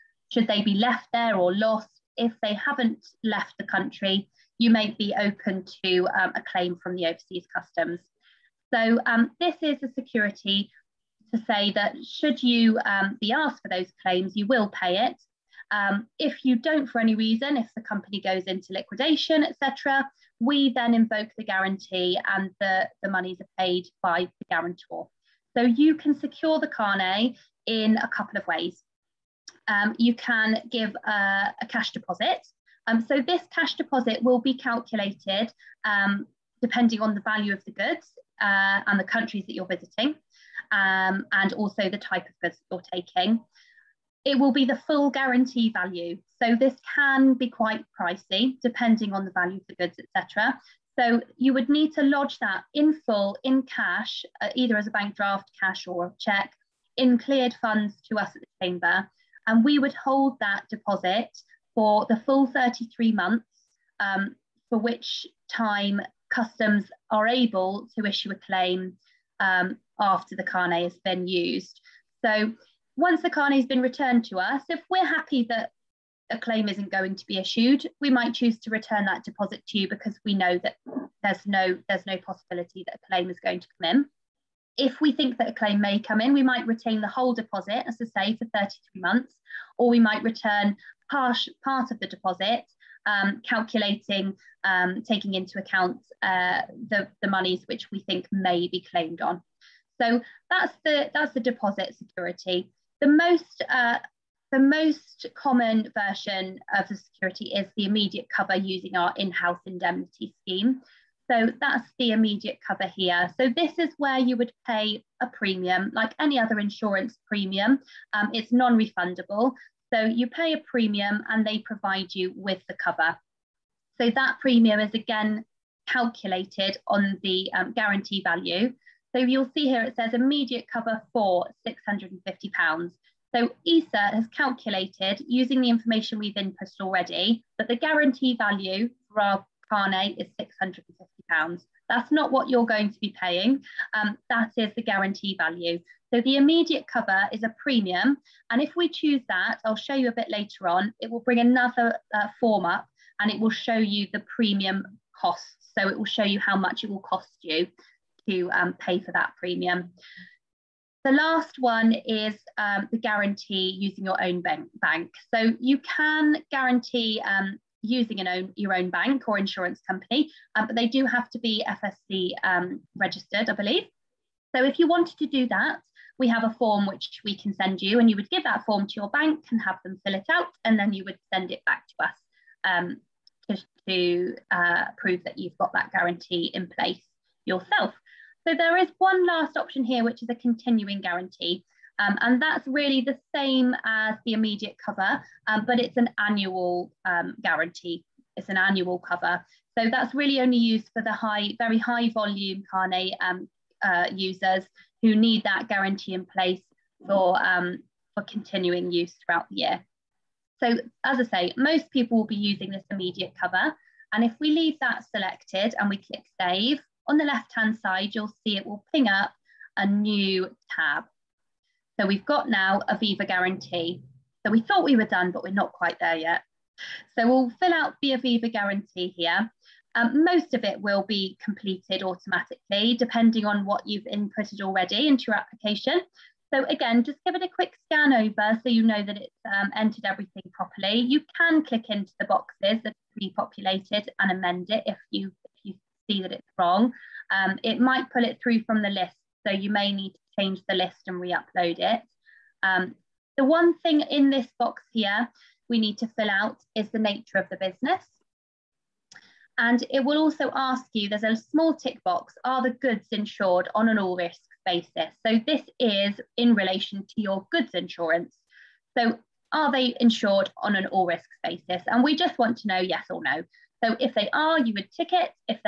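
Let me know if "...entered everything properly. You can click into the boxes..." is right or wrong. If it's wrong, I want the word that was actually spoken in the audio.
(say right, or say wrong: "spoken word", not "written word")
right.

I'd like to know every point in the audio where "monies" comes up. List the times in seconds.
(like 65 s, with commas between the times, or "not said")
23 s, 97 s.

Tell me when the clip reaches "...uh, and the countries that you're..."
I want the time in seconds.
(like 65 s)
38 s.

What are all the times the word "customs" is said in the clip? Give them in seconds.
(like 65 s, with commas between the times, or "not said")
7 s, 66 s.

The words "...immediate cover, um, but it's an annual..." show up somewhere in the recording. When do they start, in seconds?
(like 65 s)
194 s.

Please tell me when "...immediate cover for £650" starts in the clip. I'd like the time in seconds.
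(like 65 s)
130 s.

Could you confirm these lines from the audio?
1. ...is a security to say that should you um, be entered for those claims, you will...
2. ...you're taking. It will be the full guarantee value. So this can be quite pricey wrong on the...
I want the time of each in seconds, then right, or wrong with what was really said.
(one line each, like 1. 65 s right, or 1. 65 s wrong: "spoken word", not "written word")
1. 9 s wrong: "asked", not "entered"
2. 42 s wrong: "depending", not "wrong".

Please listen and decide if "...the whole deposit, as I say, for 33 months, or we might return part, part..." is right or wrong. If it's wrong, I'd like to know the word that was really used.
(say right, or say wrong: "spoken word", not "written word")
right.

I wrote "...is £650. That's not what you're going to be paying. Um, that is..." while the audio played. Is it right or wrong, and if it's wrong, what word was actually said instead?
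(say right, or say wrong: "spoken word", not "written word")
right.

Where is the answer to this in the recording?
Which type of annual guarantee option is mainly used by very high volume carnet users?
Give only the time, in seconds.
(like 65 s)
190 s.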